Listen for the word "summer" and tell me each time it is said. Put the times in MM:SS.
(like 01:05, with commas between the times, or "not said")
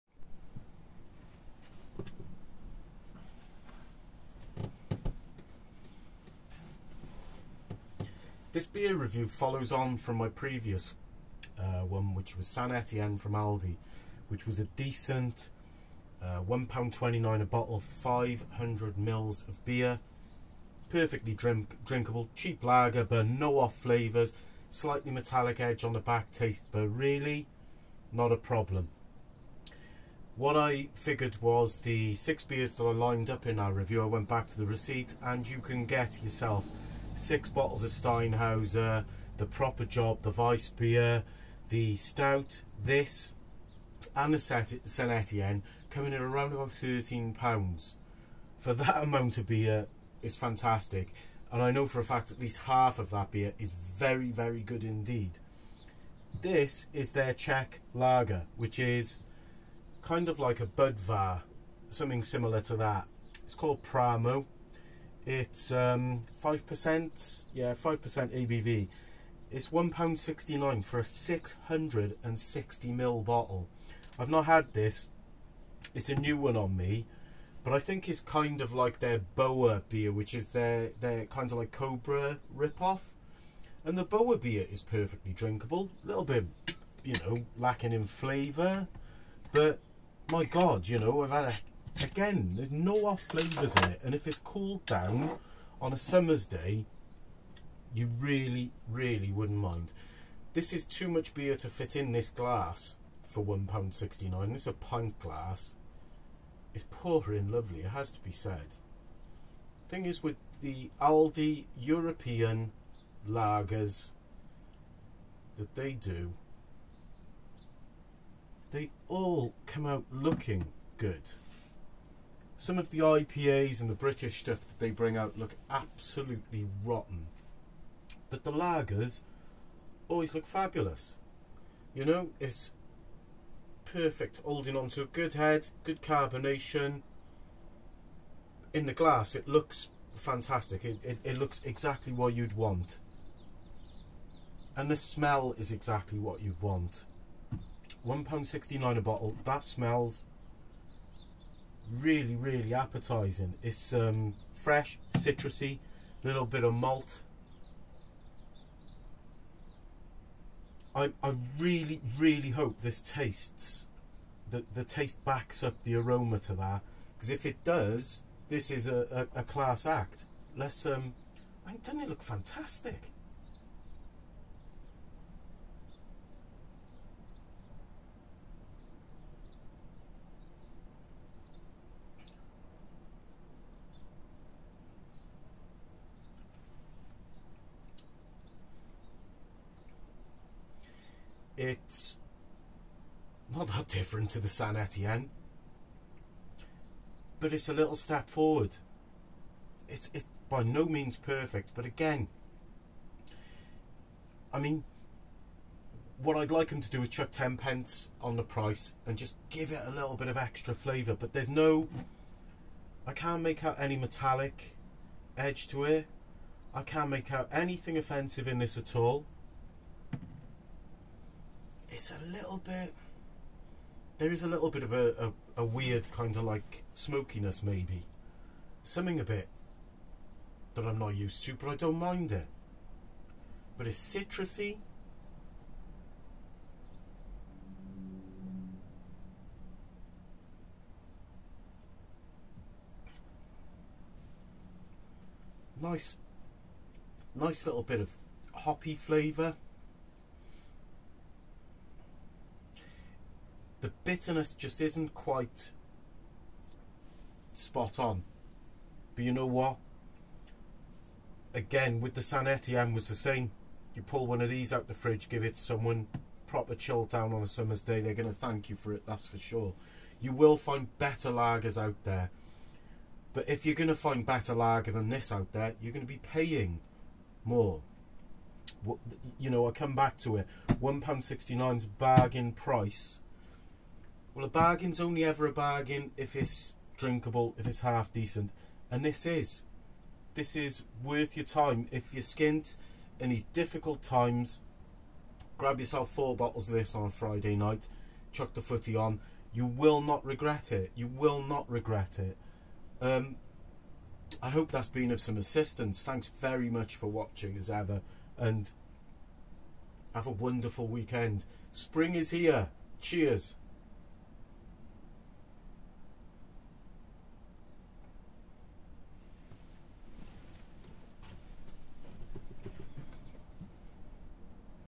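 01:35, 04:27.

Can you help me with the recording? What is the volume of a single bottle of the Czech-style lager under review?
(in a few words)
660ml.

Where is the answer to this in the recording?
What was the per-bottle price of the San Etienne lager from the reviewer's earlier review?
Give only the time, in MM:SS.
00:16.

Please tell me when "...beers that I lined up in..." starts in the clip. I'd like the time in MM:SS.
00:32.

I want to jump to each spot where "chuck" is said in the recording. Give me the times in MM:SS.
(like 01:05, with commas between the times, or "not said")
03:27, 04:58.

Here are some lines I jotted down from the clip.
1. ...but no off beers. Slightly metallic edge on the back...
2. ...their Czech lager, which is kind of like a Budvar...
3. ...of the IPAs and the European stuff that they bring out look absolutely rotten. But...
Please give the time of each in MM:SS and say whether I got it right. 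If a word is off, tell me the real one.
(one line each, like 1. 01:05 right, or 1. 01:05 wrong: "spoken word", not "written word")
1. 00:23 wrong: "flavours", not "beers"
2. 00:57 right
3. 02:02 wrong: "British", not "European".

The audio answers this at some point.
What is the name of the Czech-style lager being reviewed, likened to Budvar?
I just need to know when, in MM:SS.
01:03.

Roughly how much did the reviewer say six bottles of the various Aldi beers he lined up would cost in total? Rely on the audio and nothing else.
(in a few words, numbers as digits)
£13.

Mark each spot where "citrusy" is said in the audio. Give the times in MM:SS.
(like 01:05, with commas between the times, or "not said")
02:35, 03:54.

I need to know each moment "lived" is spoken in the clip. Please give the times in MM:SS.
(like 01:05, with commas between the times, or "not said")
not said.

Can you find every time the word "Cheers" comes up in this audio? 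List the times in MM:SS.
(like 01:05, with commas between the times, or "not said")
05:13.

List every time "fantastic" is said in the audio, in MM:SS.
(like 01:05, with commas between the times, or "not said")
00:50, 02:20, 02:52.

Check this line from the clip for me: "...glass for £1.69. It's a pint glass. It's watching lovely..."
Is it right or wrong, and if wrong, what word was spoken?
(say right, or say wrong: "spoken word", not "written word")
wrong: "pouring", not "watching".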